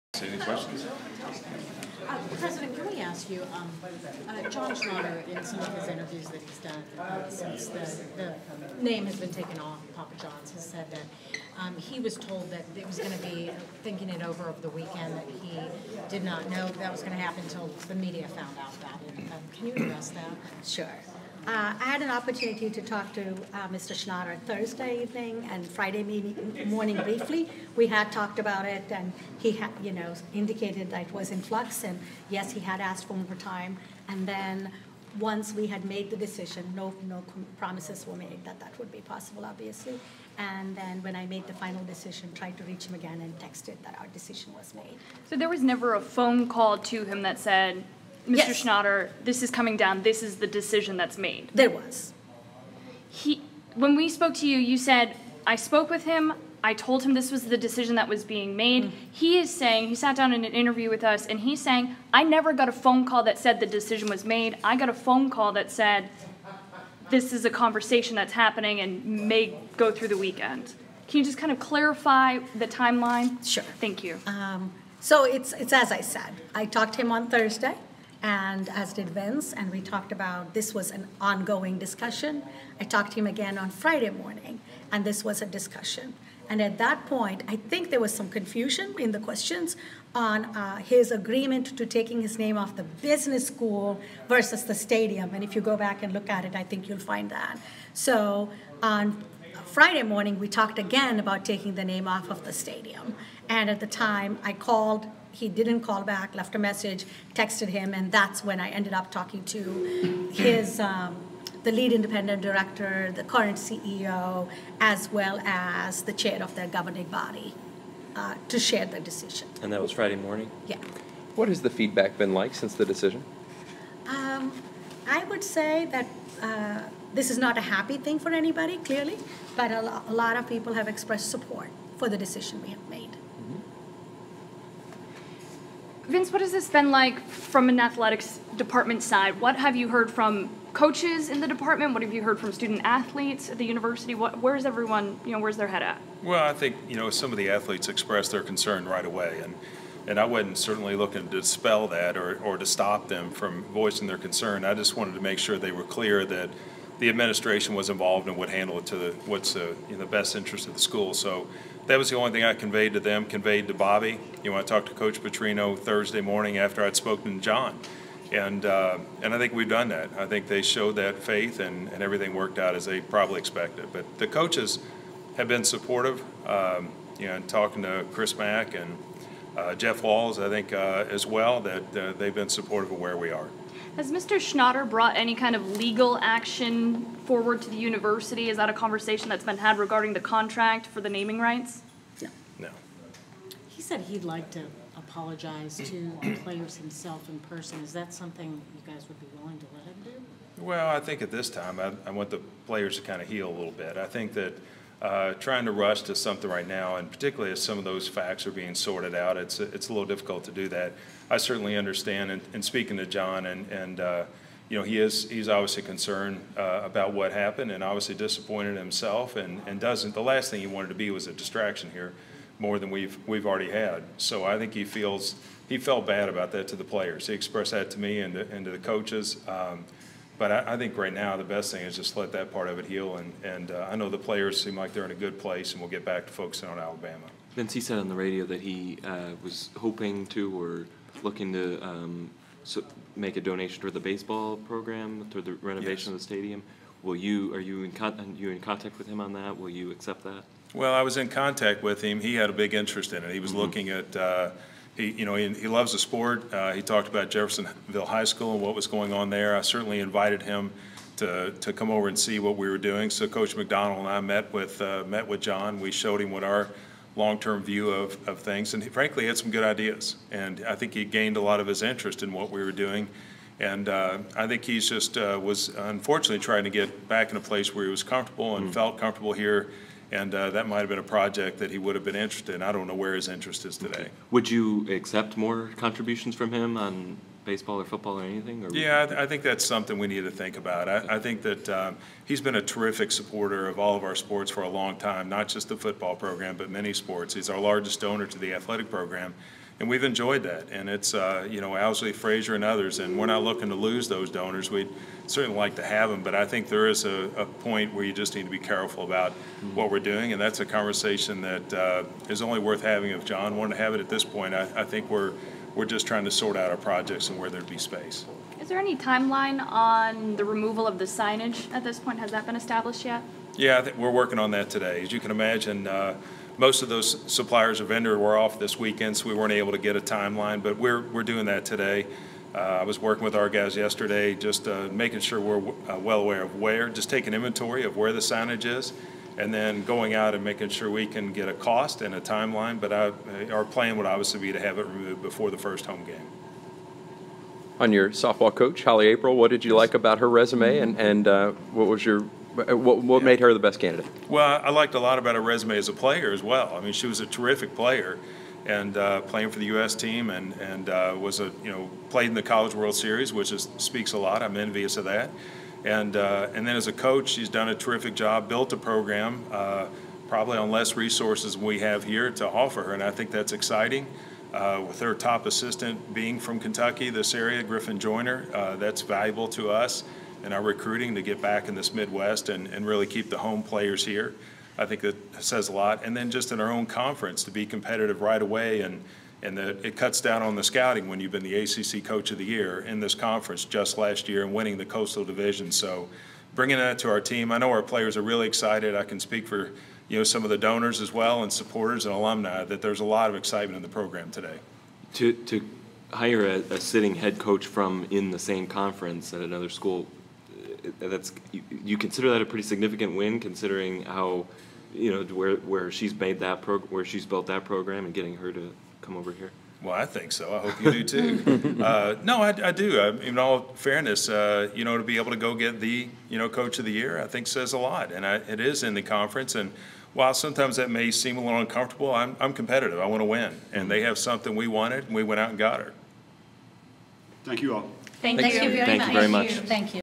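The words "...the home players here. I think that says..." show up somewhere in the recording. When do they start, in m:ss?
6:23.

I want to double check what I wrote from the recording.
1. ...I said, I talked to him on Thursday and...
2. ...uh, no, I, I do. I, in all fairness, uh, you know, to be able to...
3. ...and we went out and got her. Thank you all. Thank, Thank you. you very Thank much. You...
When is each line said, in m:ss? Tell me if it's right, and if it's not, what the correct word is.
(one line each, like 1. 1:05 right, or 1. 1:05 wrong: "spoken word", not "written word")
1. 1:15 right
2. 7:01 right
3. 7:15 right.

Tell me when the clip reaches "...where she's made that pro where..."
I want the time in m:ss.
6:55.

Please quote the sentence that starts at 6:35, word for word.
So bringing that to our team, I know our players are really excited.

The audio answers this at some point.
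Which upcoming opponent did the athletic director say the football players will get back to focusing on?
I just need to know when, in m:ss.
3:56.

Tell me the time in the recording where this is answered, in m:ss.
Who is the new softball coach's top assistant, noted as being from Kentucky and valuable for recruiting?
6:17.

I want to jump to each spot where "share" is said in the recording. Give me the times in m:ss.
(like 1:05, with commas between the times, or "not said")
1:58.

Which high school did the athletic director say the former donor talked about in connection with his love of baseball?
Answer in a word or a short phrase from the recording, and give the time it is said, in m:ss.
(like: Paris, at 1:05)
Jeffersonville High School, at 4:17.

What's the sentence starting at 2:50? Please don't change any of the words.
I think they showed that faith and, and everything worked out as they probably expected.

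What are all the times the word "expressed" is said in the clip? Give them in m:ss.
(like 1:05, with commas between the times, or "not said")
2:10, 2:27, 3:47.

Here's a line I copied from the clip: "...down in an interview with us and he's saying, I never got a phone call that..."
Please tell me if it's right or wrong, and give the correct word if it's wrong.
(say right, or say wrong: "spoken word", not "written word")
right.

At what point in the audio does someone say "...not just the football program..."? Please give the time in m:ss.
4:55.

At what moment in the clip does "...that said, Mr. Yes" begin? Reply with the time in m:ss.
0:47.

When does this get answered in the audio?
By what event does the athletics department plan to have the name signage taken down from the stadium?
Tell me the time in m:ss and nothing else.
5:45.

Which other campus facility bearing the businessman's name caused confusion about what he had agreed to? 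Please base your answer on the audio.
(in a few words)
business school.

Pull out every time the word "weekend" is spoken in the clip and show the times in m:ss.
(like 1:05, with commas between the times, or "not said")
0:14, 1:10, 5:28.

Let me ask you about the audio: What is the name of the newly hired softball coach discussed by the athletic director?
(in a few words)
Holly Aprile.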